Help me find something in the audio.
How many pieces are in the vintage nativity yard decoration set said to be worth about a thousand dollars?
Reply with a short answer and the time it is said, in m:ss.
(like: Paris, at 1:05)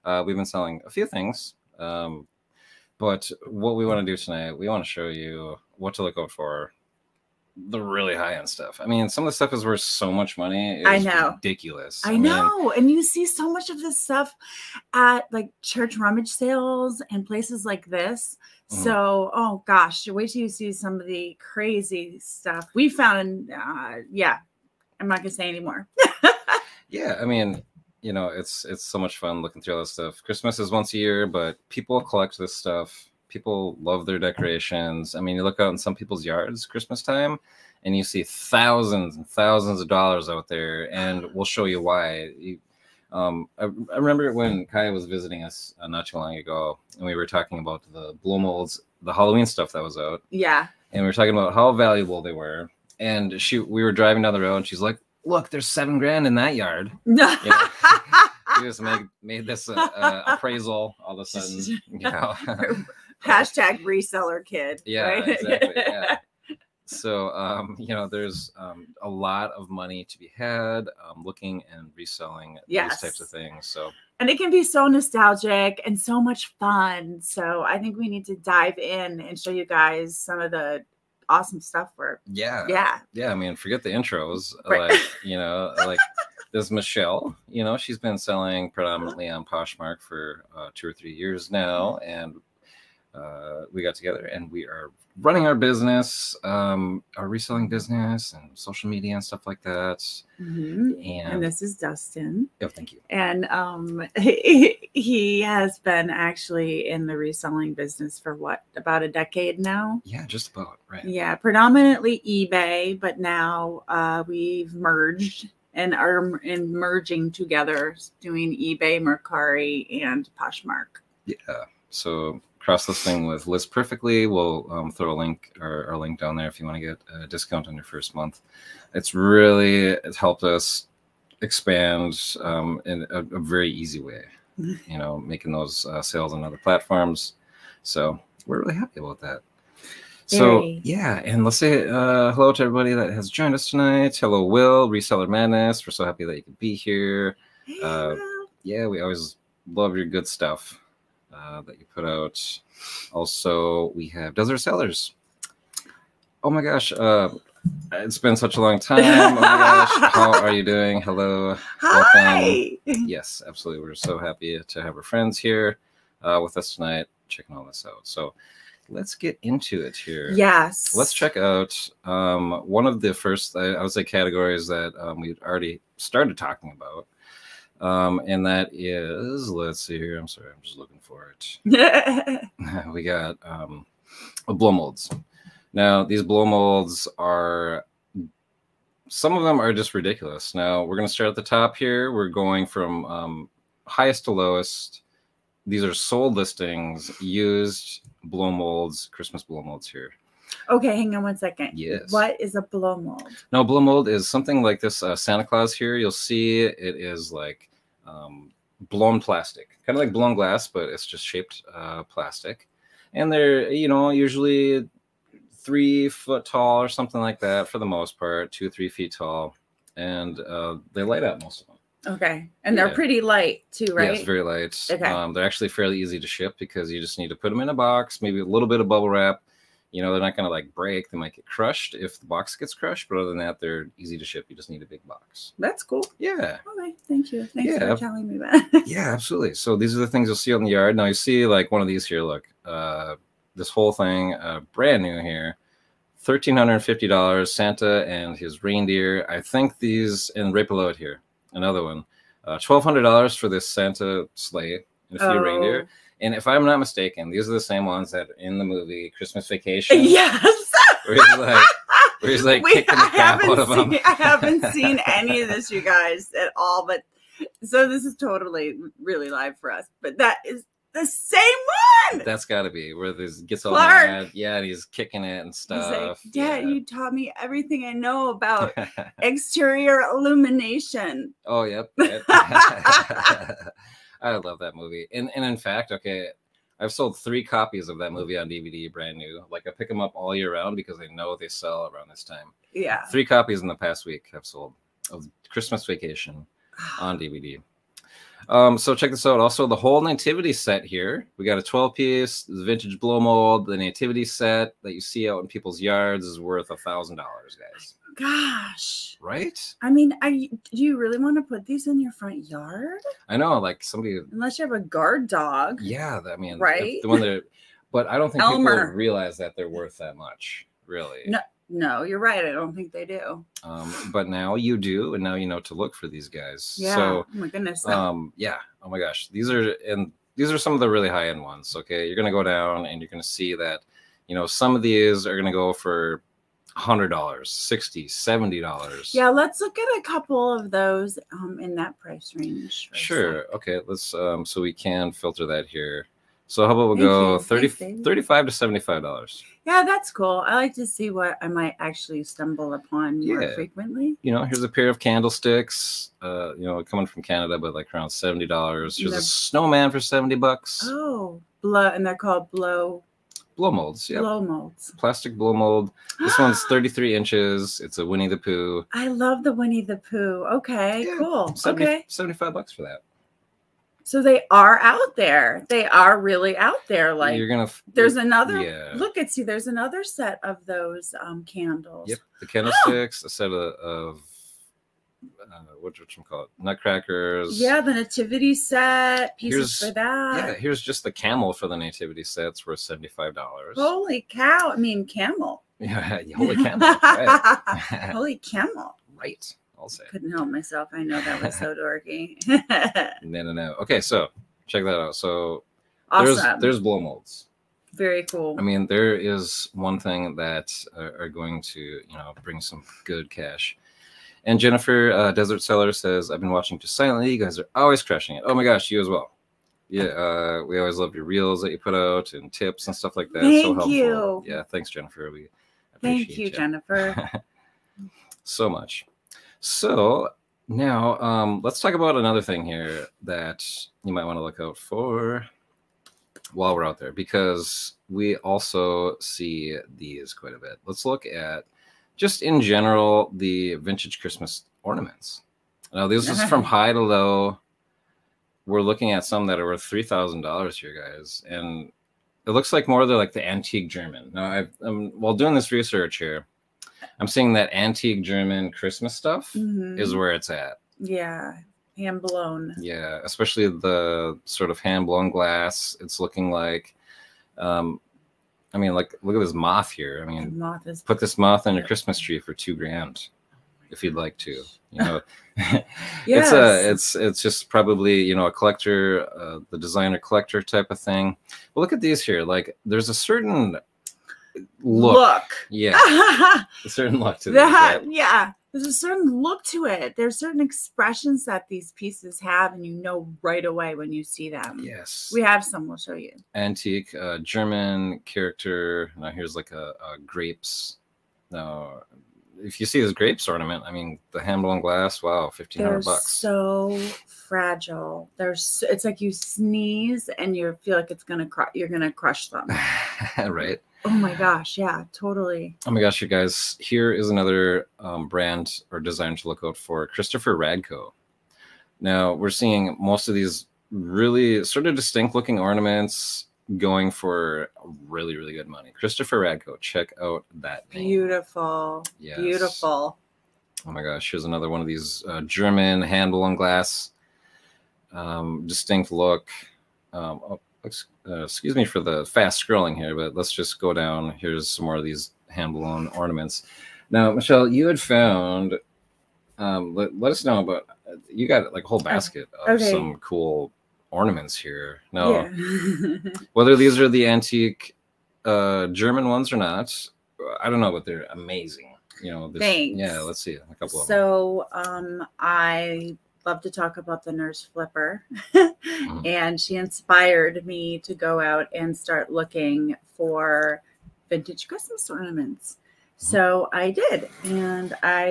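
12, at 5:01.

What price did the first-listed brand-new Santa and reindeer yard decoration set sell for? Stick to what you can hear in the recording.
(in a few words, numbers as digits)
$1,350.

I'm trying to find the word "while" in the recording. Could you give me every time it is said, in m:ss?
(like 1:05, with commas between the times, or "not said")
7:16, 7:35.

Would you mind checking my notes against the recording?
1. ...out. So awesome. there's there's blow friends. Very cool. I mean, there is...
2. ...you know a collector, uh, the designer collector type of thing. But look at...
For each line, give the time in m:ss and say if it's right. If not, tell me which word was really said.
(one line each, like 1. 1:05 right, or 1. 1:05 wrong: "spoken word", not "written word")
1. 6:44 wrong: "molds", not "friends"
2. 7:58 right.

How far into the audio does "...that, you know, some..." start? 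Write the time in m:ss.
5:33.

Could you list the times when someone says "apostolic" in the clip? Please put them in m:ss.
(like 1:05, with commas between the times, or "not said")
not said.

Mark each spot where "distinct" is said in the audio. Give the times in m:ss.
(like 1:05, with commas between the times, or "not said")
8:44, 8:58.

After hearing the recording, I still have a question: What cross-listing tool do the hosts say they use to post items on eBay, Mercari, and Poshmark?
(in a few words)
List Perfectly.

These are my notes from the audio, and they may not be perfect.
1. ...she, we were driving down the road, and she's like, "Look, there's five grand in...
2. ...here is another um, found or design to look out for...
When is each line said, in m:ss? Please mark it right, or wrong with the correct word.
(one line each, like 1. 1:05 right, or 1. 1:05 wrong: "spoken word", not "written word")
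1. 0:53 wrong: "seven", not "five"
2. 8:36 wrong: "brand", not "found".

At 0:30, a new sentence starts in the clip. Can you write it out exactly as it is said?
Christmas is once a year, but people collect this stuff people love their decorations.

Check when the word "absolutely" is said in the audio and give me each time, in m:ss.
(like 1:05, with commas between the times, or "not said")
2:43, 3:59.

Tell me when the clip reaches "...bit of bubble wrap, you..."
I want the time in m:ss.
3:48.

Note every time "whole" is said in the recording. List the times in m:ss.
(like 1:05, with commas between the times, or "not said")
4:03, 4:59, 9:11.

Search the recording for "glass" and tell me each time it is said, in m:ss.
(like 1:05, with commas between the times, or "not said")
3:30, 7:45, 8:24, 8:56.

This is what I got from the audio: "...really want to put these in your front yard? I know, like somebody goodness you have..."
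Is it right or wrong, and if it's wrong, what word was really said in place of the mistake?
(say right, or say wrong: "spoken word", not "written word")
wrong: "unless", not "goodness".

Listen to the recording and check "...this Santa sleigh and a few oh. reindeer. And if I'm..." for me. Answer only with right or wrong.
right.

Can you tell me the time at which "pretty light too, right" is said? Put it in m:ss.
3:42.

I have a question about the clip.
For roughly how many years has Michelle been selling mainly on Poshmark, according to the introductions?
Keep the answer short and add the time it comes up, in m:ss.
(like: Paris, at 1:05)
2 or 3 years, at 1:30.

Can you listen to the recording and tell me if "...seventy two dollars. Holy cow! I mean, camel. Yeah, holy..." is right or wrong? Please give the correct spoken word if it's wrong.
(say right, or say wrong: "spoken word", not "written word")
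wrong: "five", not "two".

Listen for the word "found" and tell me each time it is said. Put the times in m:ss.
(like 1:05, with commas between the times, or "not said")
0:22, 9:07.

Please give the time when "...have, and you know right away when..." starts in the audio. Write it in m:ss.
8:12.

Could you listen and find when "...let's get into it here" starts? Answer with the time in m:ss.
2:48.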